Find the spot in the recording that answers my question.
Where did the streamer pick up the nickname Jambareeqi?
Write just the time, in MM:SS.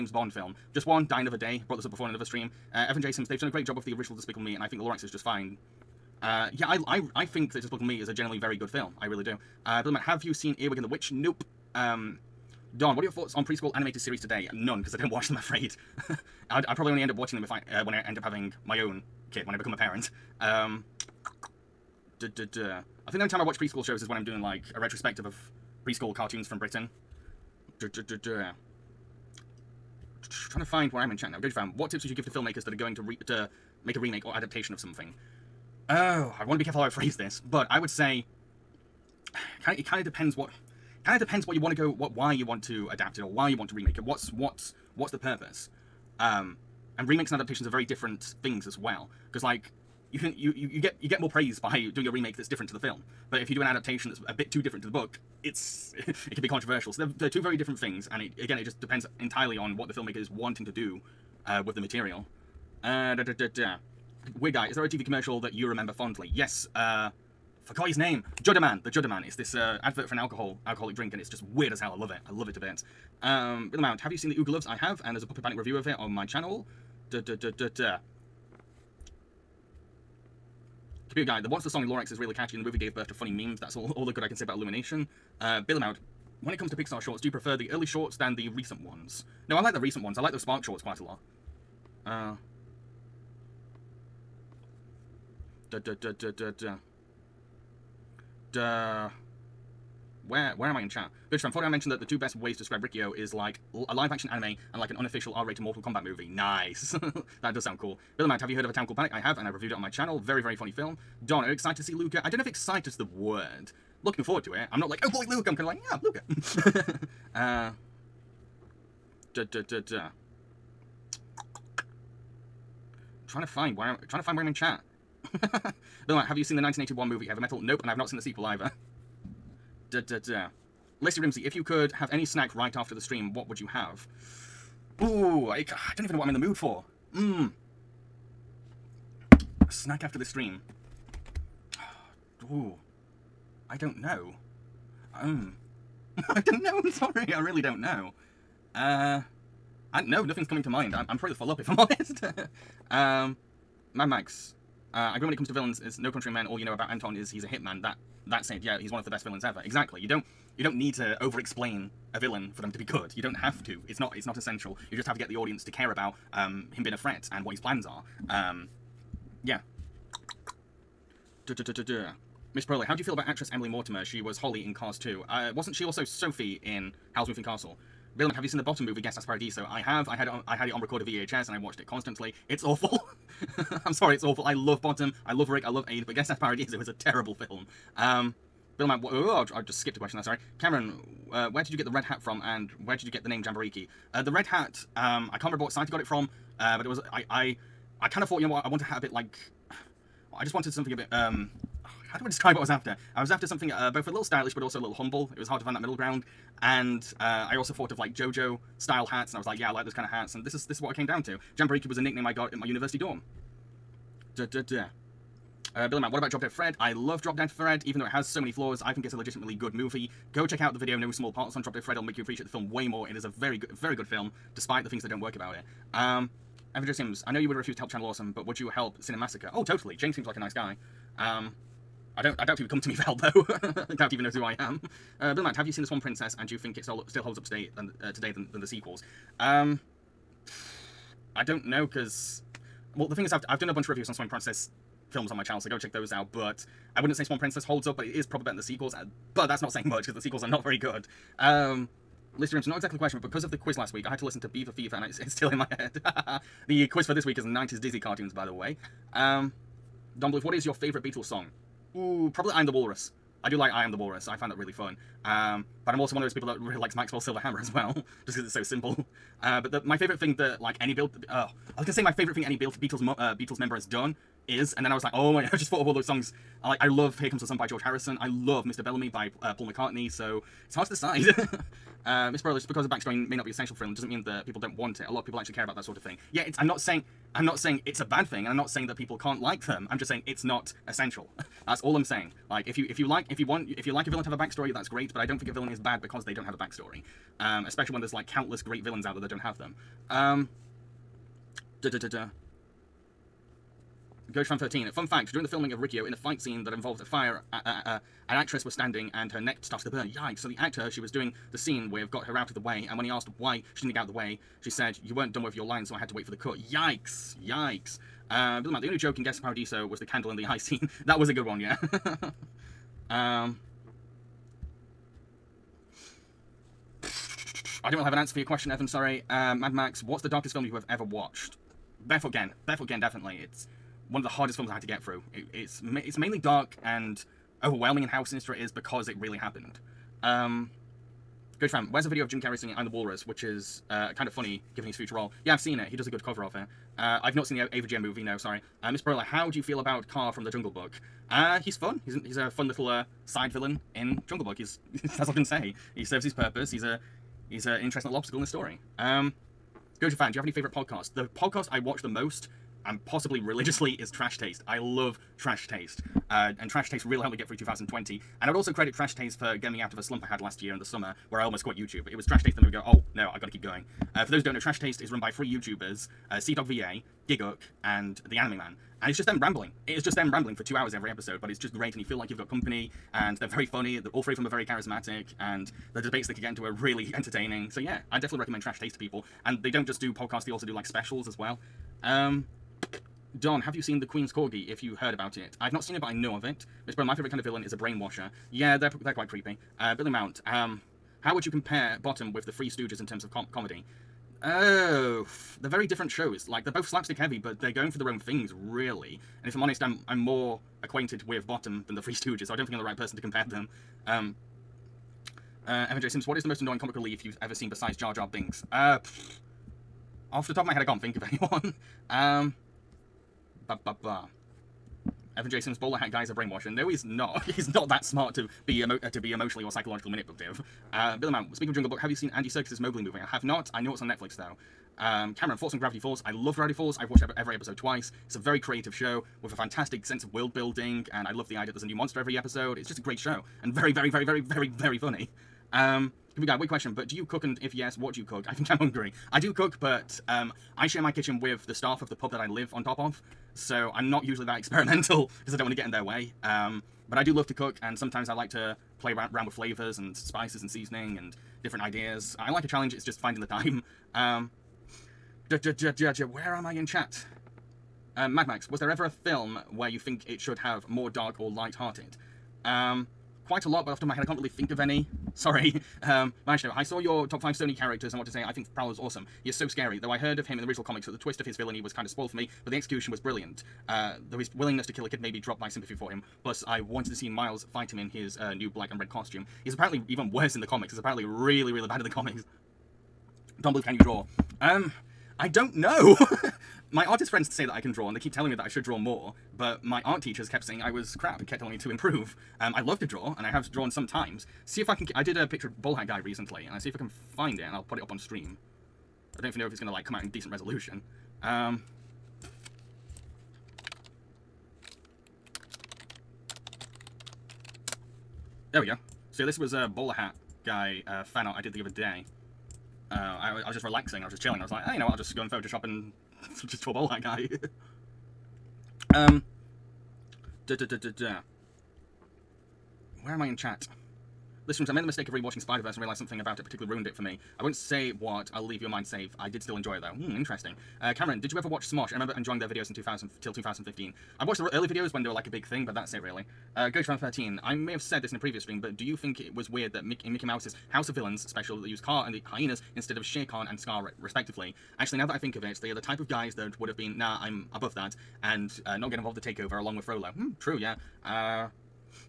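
03:32.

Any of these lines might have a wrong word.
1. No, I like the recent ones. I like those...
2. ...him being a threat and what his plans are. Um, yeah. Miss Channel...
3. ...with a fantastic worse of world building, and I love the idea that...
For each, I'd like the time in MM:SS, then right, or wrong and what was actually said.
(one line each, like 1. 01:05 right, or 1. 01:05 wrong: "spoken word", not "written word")
1. 01:29 right
2. 02:46 wrong: "Proley", not "Channel"
3. 07:19 wrong: "sense", not "worse".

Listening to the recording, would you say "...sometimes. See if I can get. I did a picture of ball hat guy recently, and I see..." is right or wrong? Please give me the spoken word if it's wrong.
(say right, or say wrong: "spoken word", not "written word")
right.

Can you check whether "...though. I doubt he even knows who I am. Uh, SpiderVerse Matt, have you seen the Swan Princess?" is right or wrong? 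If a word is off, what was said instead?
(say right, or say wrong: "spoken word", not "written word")
wrong: "Bill", not "SpiderVerse".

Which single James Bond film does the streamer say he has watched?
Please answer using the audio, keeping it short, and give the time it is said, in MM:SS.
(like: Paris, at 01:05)
Die Another Day, at 00:01.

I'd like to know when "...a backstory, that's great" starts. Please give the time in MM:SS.
04:54.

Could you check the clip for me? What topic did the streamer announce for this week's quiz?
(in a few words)
90s Disney cartoons.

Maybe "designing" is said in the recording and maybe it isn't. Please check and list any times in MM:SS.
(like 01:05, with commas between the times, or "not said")
not said.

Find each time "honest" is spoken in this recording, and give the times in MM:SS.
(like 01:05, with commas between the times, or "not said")
02:31, 06:49.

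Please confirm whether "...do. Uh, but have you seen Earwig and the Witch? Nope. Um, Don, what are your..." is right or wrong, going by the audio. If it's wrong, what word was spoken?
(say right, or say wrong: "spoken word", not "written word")
right.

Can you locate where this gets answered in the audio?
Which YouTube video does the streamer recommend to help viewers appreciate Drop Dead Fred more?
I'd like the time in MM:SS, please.
03:40.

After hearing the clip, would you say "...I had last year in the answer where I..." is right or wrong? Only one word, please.
wrong.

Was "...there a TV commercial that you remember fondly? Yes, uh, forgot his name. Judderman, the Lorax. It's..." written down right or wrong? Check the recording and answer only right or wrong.
wrong.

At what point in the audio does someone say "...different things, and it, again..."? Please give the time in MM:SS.
00:57.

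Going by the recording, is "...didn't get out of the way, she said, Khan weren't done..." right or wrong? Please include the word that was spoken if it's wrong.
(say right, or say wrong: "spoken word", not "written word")
wrong: "You", not "Khan".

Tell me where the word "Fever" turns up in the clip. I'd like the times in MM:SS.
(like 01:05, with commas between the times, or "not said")
04:14.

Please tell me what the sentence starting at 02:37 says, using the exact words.
That that said, yeah, he's one of the best villains ever.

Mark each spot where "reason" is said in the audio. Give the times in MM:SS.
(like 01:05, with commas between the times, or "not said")
not said.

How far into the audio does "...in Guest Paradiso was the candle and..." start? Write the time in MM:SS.
05:19.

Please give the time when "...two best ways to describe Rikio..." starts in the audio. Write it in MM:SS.
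01:42.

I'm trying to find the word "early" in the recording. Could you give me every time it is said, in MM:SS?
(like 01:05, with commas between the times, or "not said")
01:27, 09:04.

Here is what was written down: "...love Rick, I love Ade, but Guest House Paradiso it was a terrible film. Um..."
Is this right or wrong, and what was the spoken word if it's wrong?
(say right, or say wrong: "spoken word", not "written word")
right.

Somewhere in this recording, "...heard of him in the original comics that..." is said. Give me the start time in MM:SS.
08:00.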